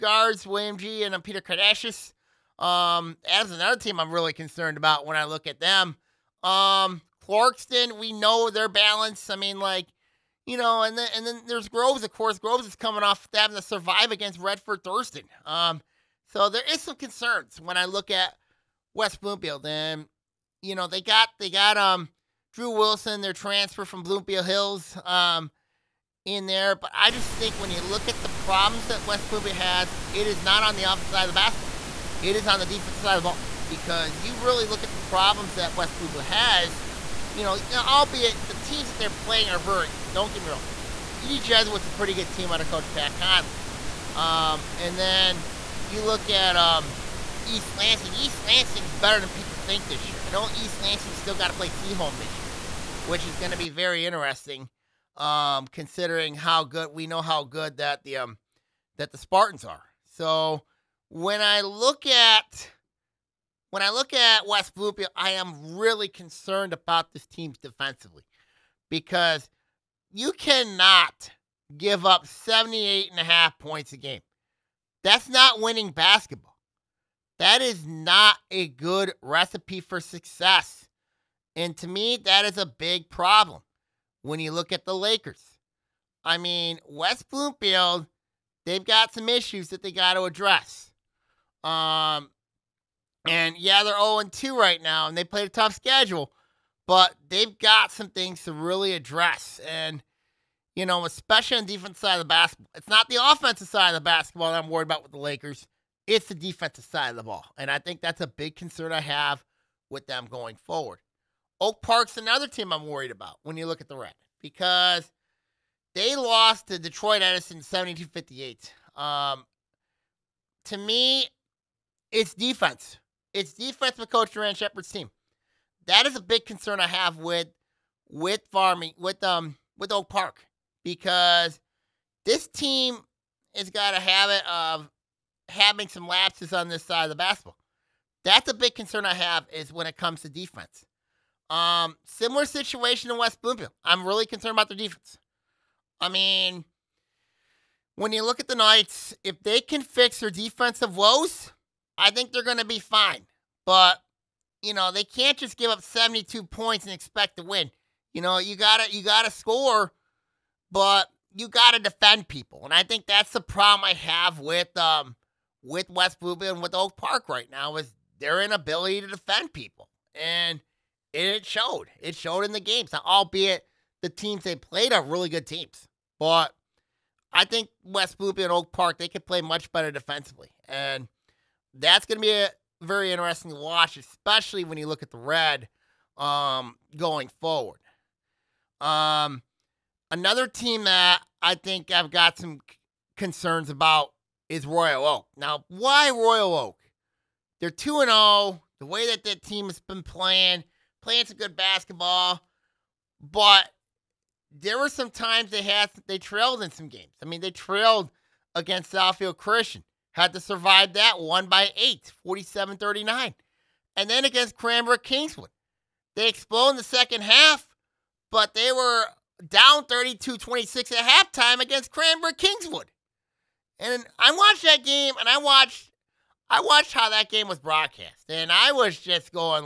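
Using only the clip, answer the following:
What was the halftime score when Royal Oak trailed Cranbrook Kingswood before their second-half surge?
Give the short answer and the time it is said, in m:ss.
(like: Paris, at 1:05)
32-26, at 3:39.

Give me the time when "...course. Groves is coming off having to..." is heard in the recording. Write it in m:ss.
0:12.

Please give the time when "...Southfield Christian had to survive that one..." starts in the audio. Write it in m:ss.
3:28.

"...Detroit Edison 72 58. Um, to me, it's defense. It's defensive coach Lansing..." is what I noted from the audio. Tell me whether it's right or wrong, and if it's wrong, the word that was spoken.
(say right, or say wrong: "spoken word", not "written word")
wrong: "Duran", not "Lansing".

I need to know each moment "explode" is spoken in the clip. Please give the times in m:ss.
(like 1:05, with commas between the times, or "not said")
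3:36.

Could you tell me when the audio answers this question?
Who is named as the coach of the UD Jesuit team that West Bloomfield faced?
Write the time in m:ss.
0:42.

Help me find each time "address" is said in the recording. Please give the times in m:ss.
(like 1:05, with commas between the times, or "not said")
1:30, 1:38.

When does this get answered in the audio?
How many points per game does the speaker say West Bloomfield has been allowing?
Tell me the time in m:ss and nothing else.
1:12.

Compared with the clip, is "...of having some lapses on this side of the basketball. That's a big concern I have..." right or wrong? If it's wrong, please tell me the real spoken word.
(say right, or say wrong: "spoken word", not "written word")
right.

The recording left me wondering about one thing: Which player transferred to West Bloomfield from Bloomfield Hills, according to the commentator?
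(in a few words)
Drew Wilson.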